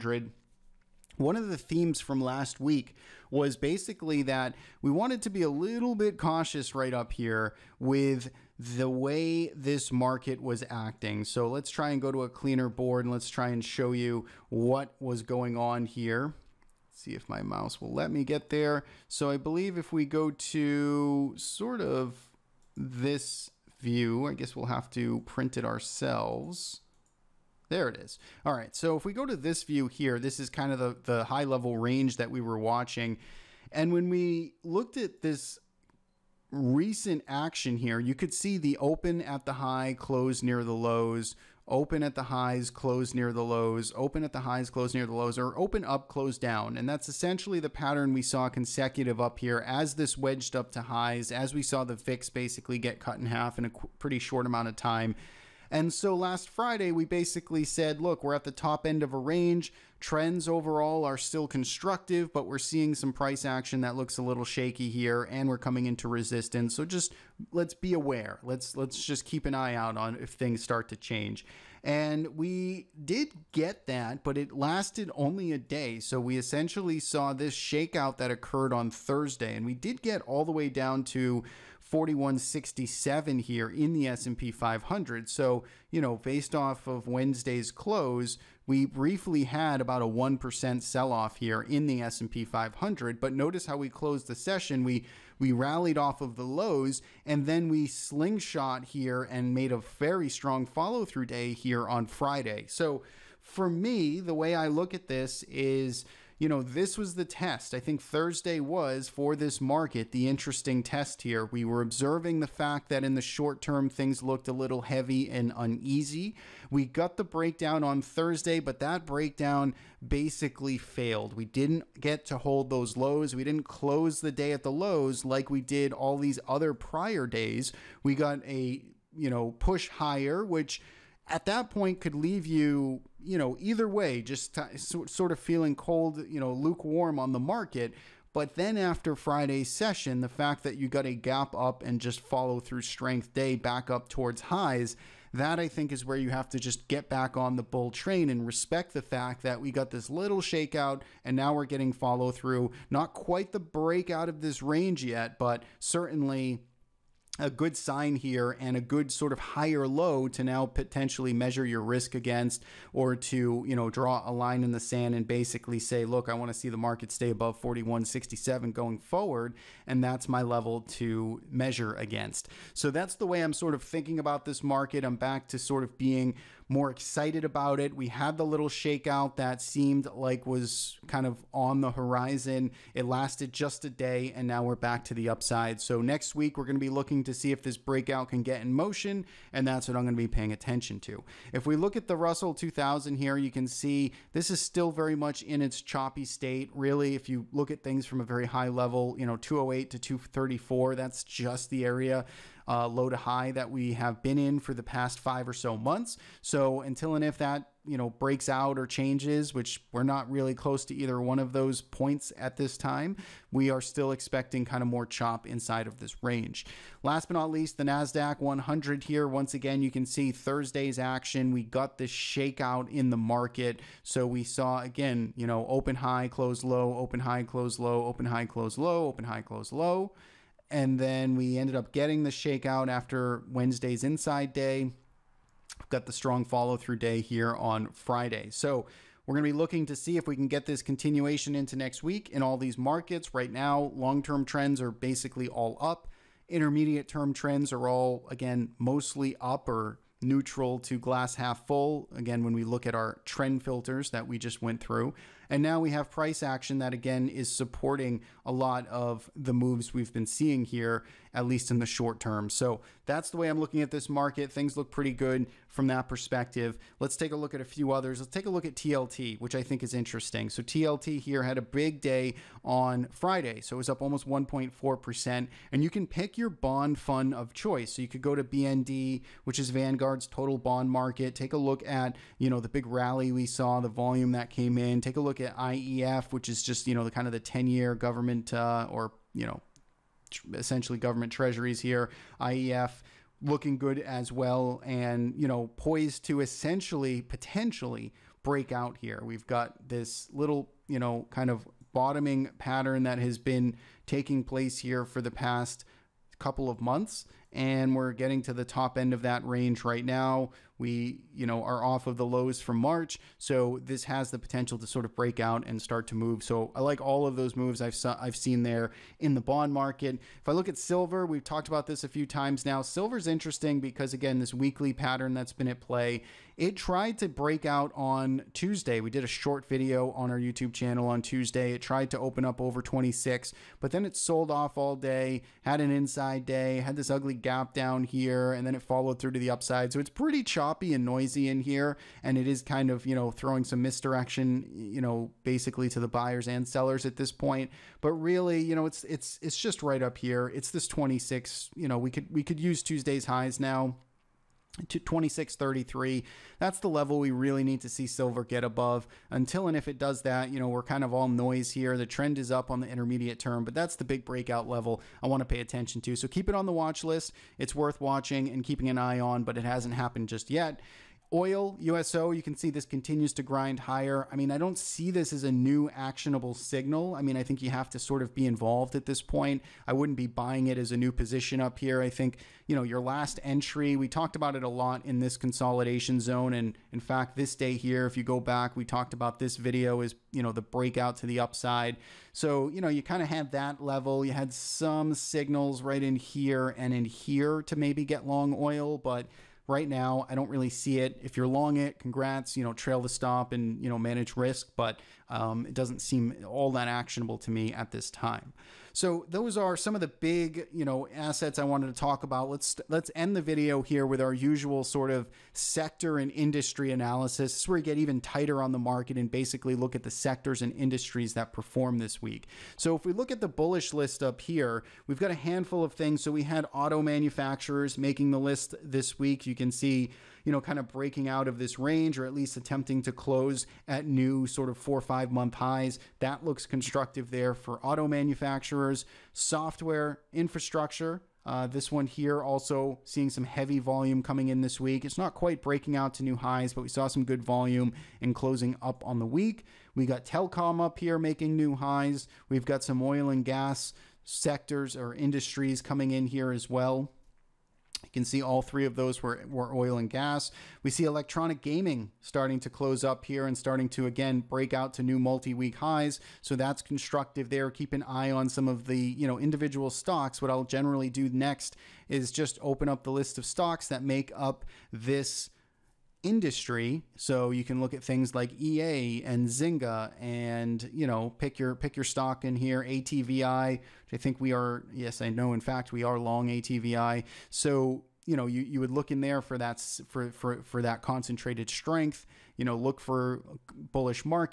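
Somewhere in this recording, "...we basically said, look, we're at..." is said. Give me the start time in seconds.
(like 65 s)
56 s.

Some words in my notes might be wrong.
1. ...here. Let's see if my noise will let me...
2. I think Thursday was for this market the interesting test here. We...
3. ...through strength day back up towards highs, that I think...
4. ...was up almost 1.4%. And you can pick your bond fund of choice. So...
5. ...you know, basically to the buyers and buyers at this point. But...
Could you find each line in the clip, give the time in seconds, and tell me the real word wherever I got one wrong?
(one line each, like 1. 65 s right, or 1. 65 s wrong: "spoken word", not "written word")
1. 15 s wrong: "mouse", not "noise"
2. 107 s right
3. 142 s right
4. 273 s right
5. 344 s wrong: "sellers", not "buyers".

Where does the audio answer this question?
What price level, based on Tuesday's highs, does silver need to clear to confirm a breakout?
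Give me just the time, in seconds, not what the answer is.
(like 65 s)
354 s.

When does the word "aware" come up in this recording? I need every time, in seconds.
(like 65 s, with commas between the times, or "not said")
67 s.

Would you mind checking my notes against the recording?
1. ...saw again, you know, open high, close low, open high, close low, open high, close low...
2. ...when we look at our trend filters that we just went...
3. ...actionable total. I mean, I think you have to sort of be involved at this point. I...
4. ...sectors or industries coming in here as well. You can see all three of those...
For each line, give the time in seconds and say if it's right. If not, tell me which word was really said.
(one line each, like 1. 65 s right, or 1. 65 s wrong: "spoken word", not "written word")
1. 224 s right
2. 252 s right
3. 375 s wrong: "signal", not "total"
4. 454 s right.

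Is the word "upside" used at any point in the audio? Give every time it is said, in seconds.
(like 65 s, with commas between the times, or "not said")
185 s, 339 s, 391 s.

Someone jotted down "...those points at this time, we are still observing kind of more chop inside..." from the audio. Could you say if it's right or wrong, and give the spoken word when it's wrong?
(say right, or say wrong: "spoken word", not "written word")
wrong: "expecting", not "observing".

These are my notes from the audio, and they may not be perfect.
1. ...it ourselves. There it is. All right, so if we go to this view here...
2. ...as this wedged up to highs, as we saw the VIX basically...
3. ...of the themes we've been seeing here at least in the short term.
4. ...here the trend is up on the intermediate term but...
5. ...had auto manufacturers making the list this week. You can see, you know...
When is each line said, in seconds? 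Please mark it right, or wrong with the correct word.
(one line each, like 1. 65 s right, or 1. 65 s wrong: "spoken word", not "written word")
1. 25 s right
2. 49 s right
3. 258 s wrong: "moves", not "themes"
4. 361 s right
5. 426 s right.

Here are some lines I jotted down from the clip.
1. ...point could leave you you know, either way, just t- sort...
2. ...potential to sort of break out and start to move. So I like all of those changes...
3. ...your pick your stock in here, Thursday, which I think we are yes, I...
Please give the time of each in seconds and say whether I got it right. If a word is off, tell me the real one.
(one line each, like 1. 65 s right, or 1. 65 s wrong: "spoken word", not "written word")
1. 131 s right
2. 314 s wrong: "moves", not "changes"
3. 481 s wrong: "ATVI", not "Thursday".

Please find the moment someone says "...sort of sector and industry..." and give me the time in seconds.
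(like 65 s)
414 s.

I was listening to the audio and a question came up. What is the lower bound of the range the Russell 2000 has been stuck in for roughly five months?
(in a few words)
208.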